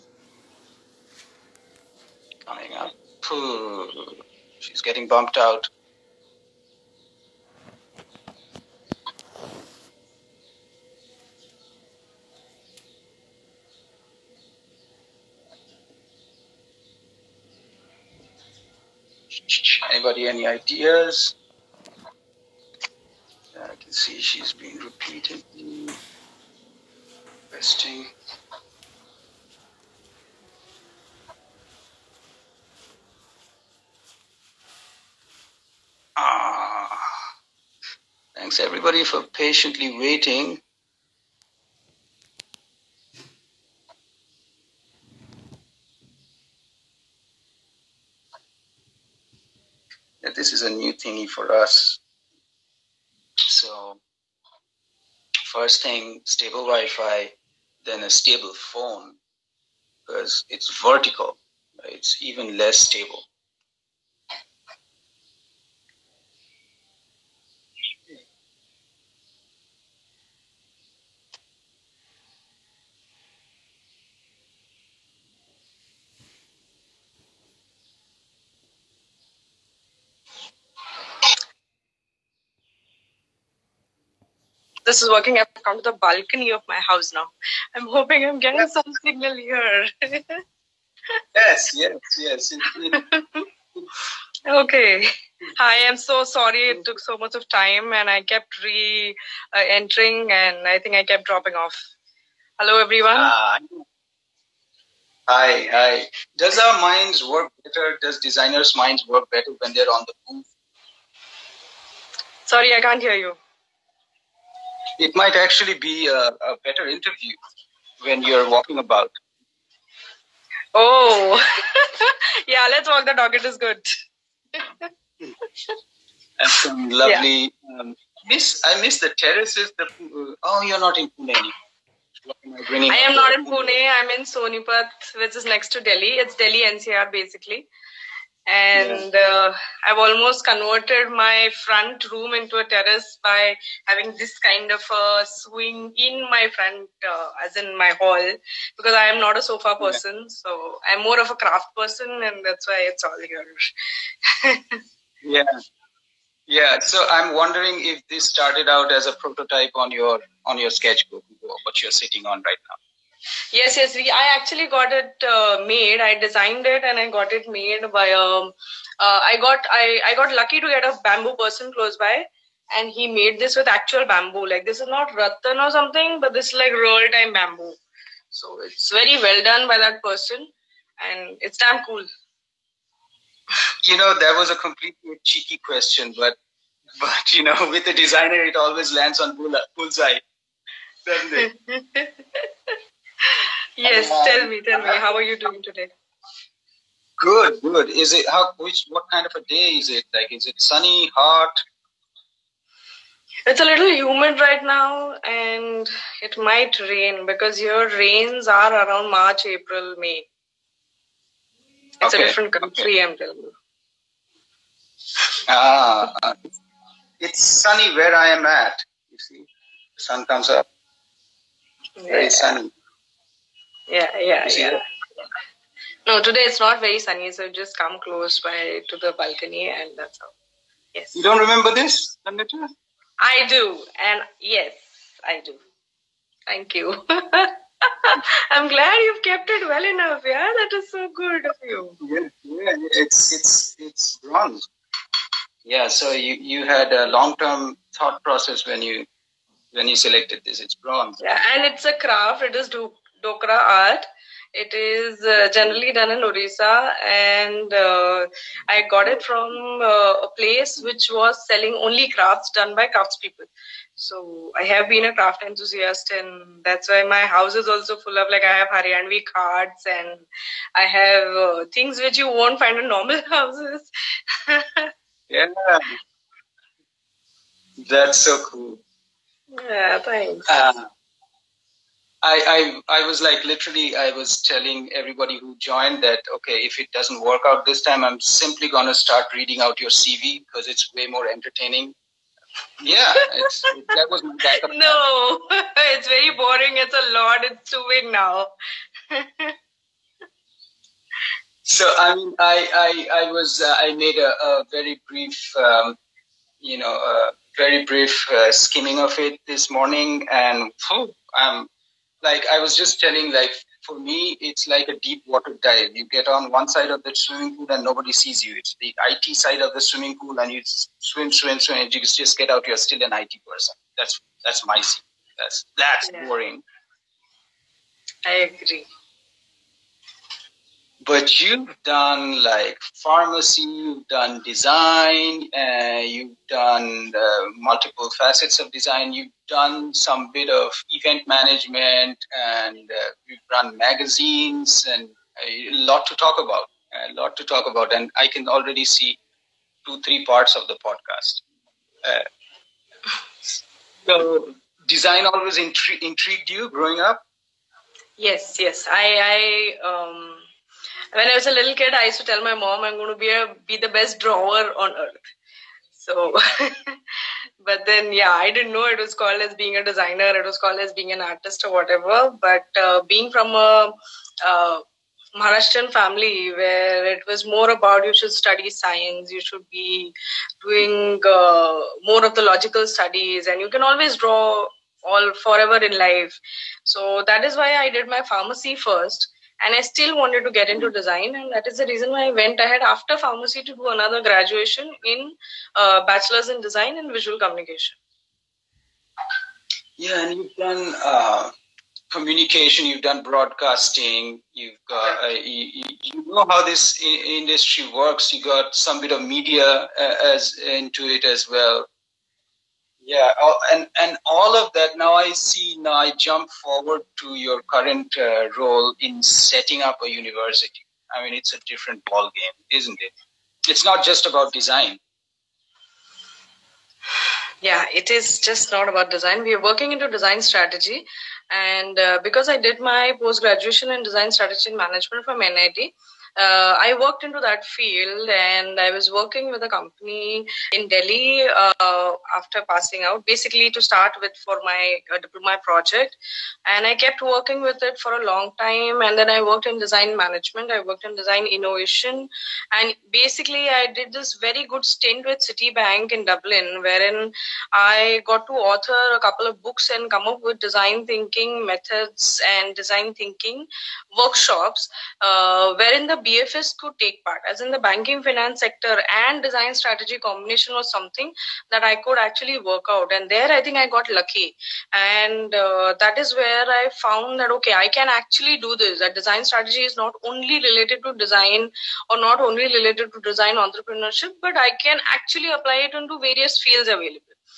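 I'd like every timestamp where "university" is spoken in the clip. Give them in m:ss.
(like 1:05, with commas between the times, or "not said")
7:00.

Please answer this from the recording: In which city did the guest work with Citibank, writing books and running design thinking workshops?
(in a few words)
Dublin.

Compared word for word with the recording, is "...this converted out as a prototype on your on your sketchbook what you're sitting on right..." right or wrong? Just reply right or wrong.
wrong.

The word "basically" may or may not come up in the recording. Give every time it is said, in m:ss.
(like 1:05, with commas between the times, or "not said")
2:17, 7:23, 7:33.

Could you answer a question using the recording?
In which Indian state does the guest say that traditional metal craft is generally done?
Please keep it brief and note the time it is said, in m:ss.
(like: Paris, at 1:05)
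Orissa, at 4:16.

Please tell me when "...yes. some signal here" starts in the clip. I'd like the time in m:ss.
1:28.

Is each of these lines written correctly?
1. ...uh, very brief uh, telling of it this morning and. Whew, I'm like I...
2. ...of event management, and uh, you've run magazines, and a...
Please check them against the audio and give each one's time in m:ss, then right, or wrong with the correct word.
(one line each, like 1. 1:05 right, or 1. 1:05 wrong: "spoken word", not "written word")
1. 5:07 wrong: "skimming", not "telling"
2. 5:40 right.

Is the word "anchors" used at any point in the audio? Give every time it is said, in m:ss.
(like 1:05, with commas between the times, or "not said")
not said.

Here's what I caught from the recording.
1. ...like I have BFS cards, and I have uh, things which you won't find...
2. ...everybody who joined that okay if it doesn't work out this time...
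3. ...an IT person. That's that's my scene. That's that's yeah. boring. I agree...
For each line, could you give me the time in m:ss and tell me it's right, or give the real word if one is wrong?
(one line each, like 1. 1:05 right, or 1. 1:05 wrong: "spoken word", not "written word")
1. 4:28 wrong: "Haryanvi", not "BFS"
2. 4:44 right
3. 5:23 right.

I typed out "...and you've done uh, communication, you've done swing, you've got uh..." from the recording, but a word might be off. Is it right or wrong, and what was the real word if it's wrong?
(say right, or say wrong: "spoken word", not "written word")
wrong: "broadcasting", not "swing".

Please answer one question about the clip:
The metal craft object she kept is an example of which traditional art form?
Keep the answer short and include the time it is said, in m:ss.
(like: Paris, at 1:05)
Dokra art, at 4:13.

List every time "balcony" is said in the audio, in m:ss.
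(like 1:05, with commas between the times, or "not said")
1:26, 3:49.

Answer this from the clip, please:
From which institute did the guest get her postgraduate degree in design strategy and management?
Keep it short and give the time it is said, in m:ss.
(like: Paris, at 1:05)
NID, at 7:15.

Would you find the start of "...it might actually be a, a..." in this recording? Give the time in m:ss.
1:54.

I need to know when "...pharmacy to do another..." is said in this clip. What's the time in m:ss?
6:33.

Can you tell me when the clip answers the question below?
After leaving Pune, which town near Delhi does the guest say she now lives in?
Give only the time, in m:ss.
2:14.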